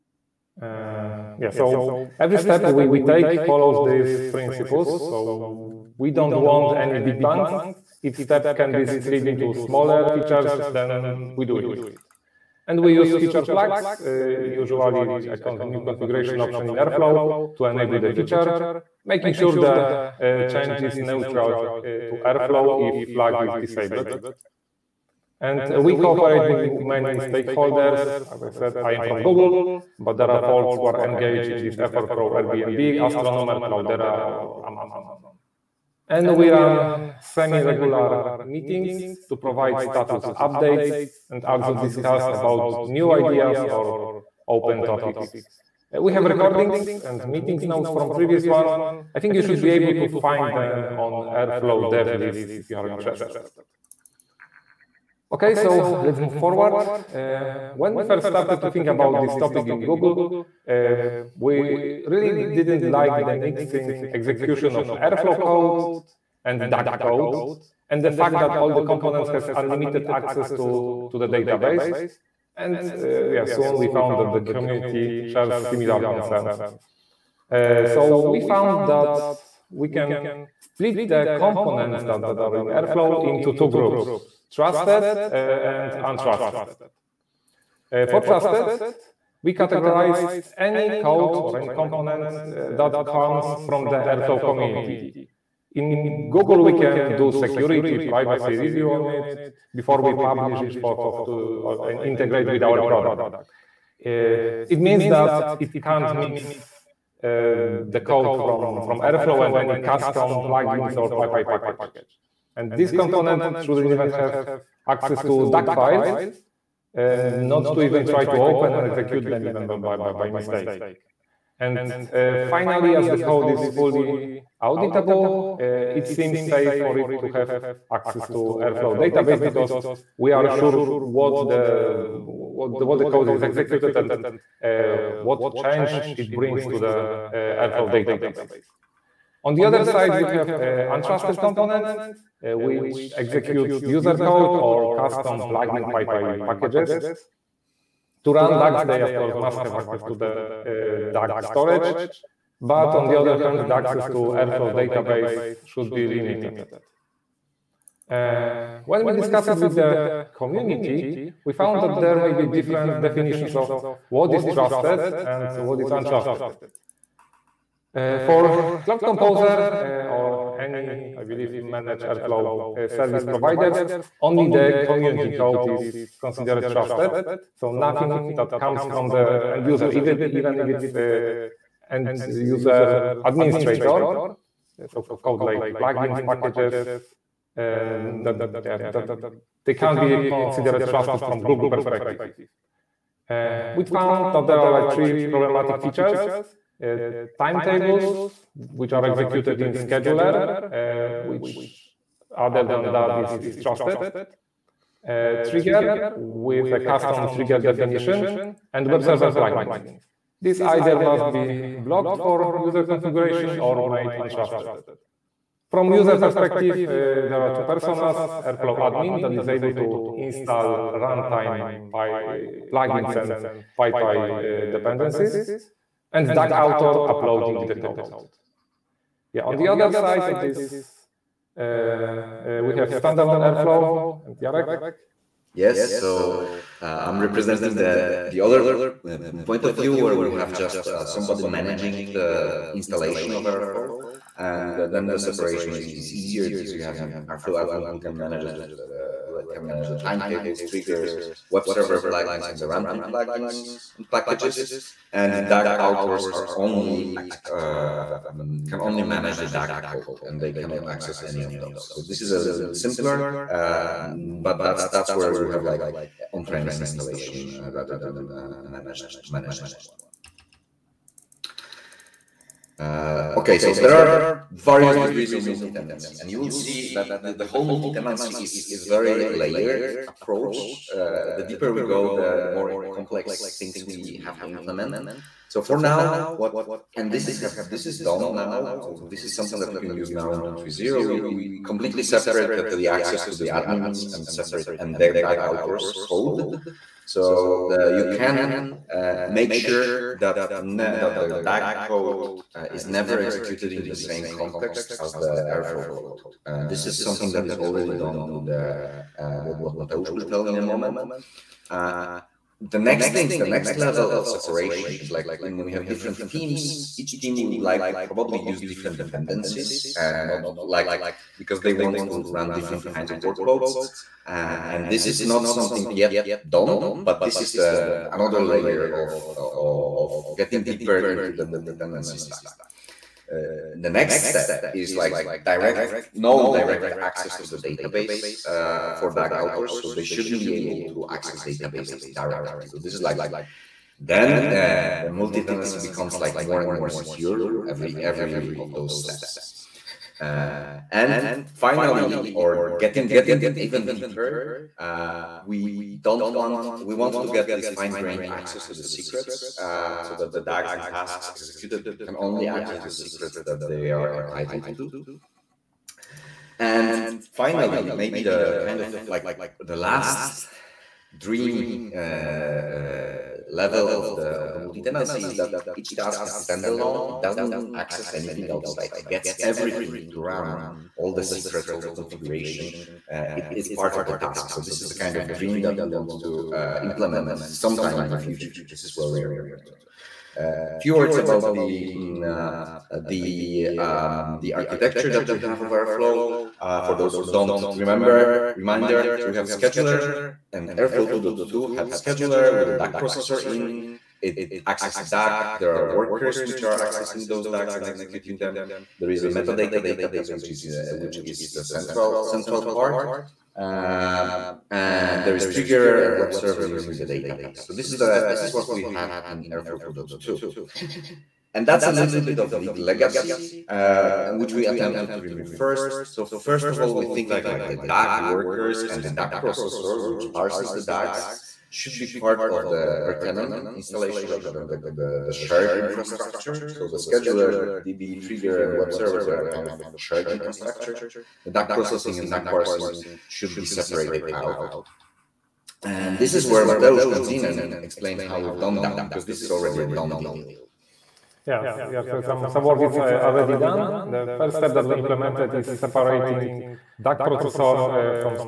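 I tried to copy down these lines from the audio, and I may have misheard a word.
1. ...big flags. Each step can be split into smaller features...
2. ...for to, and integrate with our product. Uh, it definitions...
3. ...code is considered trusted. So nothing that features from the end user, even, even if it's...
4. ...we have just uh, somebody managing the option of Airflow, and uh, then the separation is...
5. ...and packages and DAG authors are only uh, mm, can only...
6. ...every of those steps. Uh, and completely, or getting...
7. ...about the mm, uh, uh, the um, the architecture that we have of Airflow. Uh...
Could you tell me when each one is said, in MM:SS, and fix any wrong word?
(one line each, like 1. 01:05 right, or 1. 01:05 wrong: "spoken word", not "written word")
1. 00:06 wrong: "bangs", not "flags"
2. 01:40 wrong: "means", not "definitions"
3. 02:55 wrong: "comes", not "features"
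4. 04:00 wrong: "installation", not "option"
5. 04:13 right
6. 05:47 wrong: "finally", not "completely"
7. 06:31 right.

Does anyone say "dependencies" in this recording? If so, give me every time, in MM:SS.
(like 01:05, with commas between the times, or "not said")
03:44, 05:18.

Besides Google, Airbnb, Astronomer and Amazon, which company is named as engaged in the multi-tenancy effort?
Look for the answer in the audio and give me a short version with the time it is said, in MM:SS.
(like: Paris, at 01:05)
Cloudera, at 00:33.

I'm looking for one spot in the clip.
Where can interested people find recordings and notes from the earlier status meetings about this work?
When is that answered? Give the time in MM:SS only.
00:51.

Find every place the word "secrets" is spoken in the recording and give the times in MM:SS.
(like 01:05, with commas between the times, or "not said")
05:58, 06:02, 06:21.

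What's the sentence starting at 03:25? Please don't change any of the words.
Uh, trigger with a custom trigger definition and web server plugins.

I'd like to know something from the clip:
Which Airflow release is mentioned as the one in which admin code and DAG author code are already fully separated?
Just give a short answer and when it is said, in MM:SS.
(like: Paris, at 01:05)
3.0, at 04:50.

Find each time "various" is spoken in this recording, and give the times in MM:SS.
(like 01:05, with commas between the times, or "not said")
04:34.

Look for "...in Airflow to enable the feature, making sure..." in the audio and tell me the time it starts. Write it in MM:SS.
00:16.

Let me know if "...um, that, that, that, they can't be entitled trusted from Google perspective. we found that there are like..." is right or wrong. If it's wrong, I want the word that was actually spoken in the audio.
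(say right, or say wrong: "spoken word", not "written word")
wrong: "considered", not "entitled".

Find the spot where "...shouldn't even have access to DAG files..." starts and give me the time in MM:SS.
01:53.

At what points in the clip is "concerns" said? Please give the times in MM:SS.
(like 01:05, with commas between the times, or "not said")
01:16.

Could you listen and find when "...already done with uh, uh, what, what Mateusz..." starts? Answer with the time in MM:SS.
05:07.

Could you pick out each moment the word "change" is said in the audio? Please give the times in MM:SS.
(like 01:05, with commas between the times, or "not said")
00:20, 02:15.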